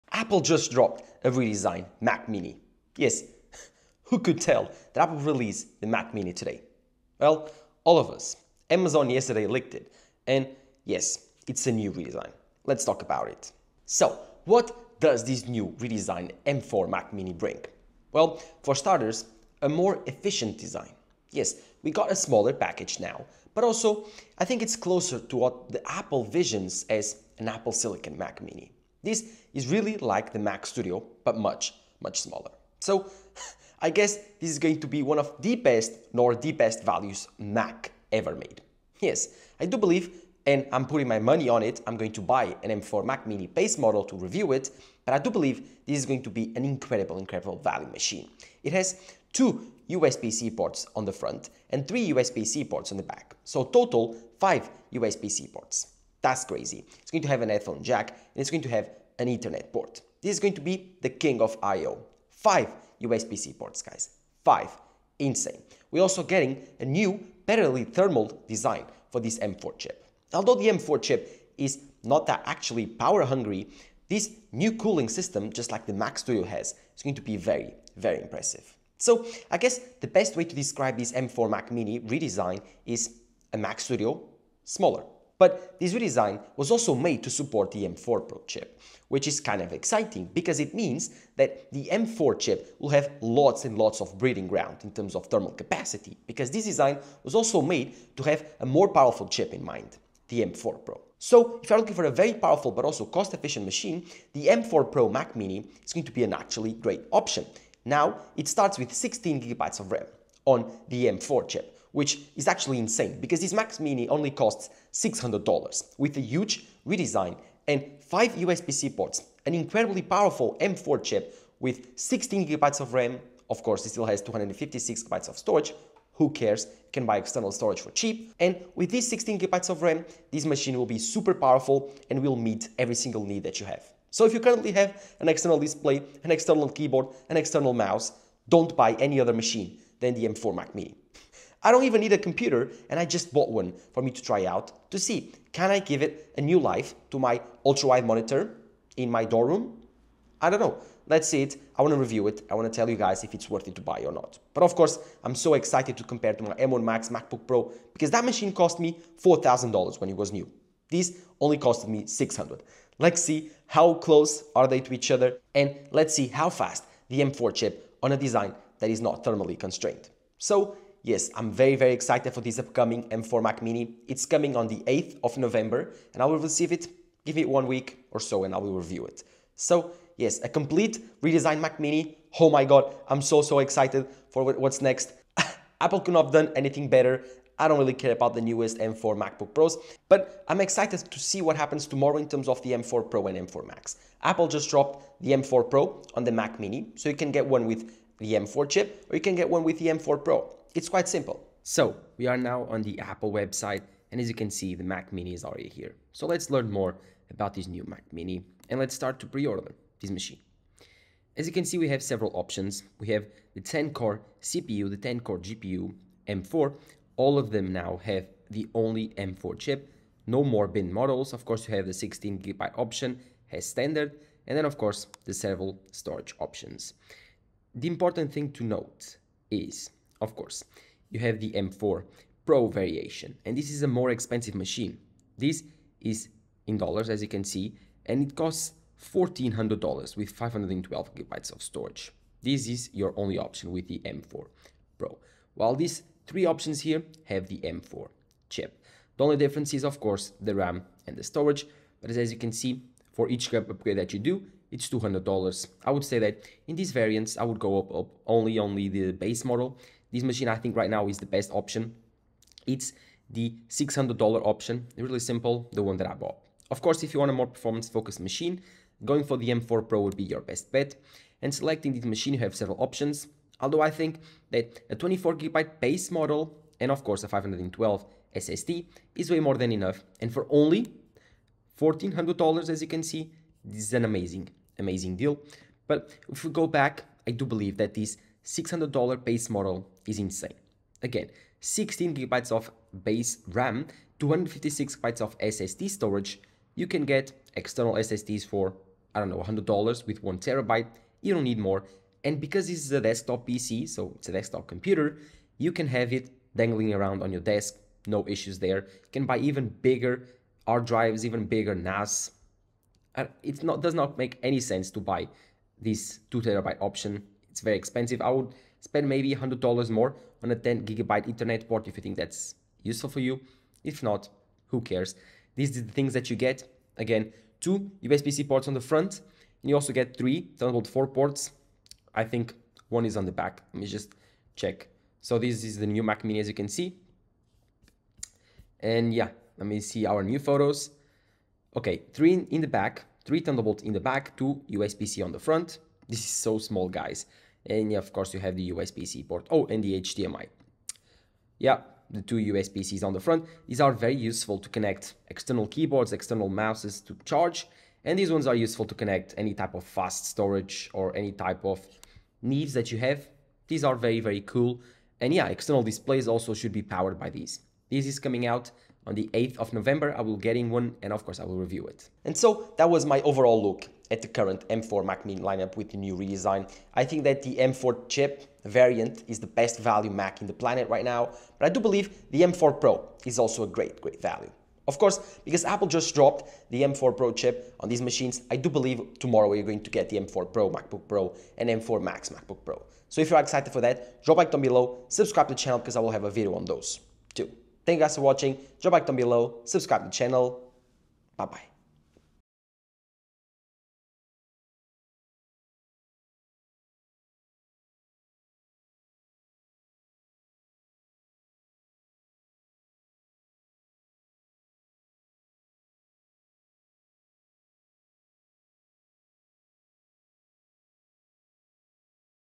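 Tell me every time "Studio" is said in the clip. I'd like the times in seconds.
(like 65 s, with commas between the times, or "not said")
30 s, 76 s, 83 s.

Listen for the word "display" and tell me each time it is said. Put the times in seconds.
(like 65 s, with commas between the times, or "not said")
135 s, 365 s.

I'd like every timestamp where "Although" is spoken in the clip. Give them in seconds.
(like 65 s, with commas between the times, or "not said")
70 s, 273 s.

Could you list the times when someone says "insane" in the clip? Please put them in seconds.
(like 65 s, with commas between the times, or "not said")
65 s, 112 s, 290 s.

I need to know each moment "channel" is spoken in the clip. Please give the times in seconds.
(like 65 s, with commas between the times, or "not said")
395 s, 400 s.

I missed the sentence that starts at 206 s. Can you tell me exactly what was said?
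So let's learn more about this new Mac Mini and let's start to pre-order this machine.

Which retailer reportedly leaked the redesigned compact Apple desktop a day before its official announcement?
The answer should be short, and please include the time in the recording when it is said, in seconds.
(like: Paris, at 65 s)
Amazon, at 8 s.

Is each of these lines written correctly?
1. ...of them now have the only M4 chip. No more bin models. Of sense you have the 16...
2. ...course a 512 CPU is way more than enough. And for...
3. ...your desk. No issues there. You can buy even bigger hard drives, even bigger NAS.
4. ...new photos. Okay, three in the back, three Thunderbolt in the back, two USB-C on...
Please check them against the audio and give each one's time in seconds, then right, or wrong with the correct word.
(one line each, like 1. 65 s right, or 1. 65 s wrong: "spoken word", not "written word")
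1. 217 s wrong: "course", not "sense"
2. 277 s wrong: "SSD", not "CPU"
3. 307 s right
4. 340 s right.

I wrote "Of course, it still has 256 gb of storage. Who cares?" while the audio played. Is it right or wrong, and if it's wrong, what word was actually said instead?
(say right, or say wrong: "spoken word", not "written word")
right.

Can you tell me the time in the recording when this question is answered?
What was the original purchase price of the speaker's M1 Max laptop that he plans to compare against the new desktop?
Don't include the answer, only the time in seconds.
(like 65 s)
159 s.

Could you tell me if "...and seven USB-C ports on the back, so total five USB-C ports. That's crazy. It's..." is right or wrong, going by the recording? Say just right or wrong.
wrong.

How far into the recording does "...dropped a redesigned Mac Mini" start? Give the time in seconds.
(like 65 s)
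0 s.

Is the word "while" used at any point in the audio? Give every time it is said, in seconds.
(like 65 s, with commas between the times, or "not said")
245 s.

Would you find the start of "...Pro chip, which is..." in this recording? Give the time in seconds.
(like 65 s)
88 s.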